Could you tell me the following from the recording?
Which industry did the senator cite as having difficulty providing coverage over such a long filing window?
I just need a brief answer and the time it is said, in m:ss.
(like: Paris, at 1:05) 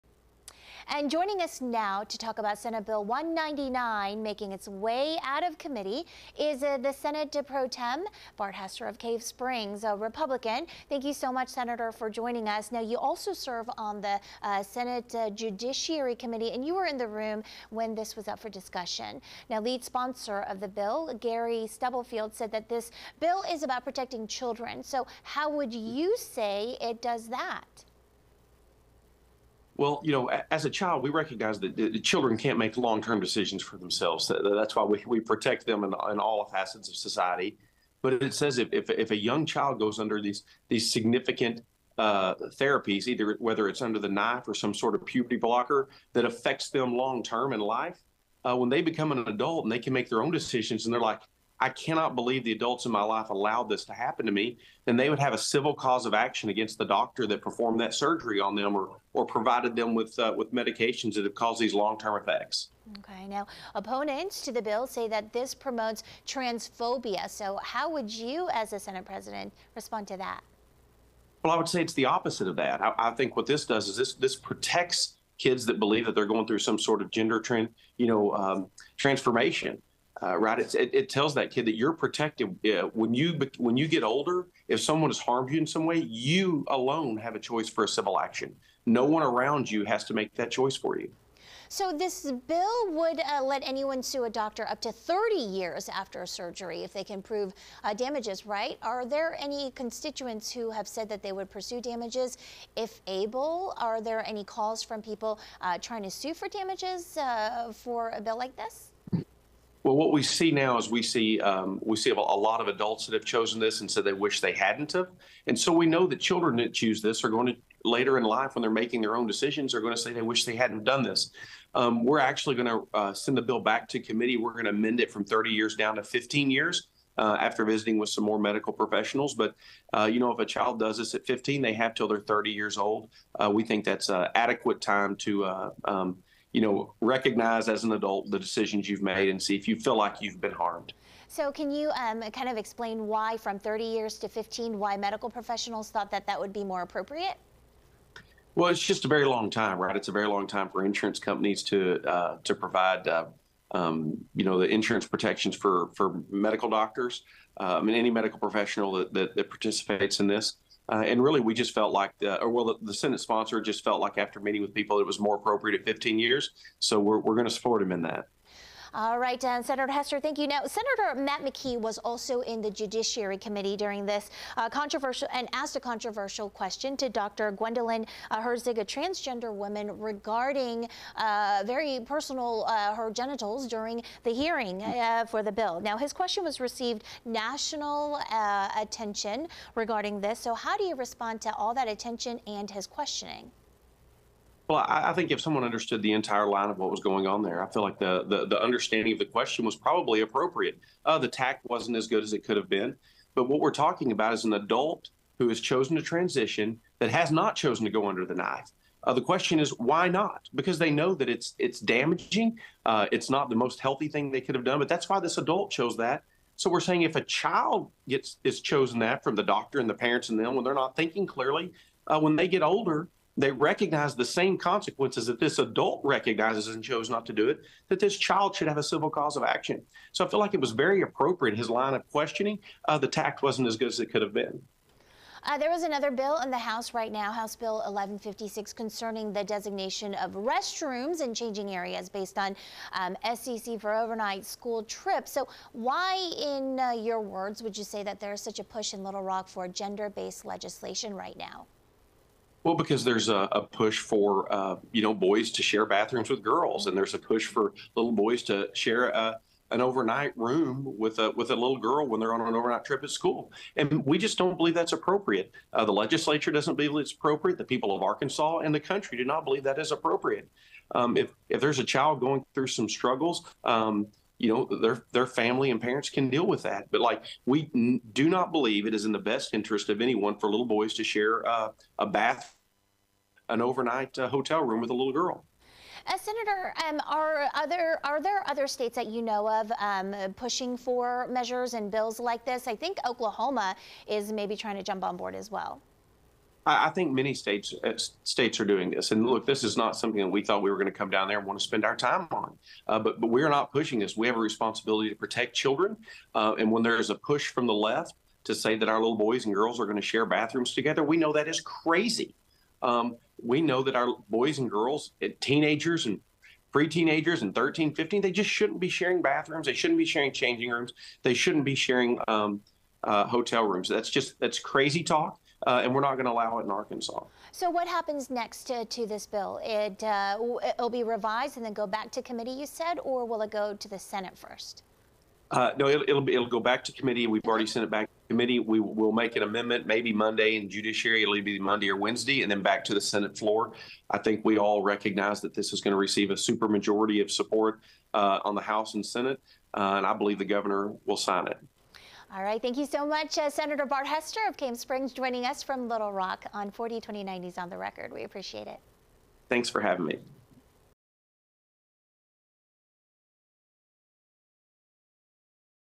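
insurance companies, at 2:30.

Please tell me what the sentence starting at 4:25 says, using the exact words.
Uh, the legislature doesn't believe it's appropriate.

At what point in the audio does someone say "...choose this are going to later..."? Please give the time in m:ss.
1:56.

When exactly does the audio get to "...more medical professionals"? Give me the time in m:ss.
2:08.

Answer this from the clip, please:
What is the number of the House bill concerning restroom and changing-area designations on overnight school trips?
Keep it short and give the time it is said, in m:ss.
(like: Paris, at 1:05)
1156, at 3:57.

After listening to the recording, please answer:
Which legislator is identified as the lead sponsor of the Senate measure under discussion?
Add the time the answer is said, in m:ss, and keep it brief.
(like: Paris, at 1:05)
Gary Stubblefield, at 0:21.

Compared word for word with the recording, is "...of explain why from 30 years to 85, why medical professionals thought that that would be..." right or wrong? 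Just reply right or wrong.
wrong.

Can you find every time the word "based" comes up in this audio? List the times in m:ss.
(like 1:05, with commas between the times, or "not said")
4:02, 4:10.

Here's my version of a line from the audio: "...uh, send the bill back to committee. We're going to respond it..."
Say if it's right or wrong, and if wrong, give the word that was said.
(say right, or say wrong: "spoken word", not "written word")
wrong: "amend", not "respond".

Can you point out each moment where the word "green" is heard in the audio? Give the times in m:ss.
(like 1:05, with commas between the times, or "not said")
not said.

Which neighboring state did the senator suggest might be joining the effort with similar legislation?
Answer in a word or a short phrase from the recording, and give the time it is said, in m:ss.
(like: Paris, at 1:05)
Oklahoma, at 4:53.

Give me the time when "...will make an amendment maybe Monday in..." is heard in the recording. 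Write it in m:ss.
5:38.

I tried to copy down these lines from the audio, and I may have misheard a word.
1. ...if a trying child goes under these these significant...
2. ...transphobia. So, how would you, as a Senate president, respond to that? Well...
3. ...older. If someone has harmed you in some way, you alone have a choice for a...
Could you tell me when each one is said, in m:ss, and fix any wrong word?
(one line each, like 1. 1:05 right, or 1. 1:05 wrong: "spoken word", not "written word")
1. 0:38 wrong: "young", not "trying"
2. 1:06 right
3. 1:24 right.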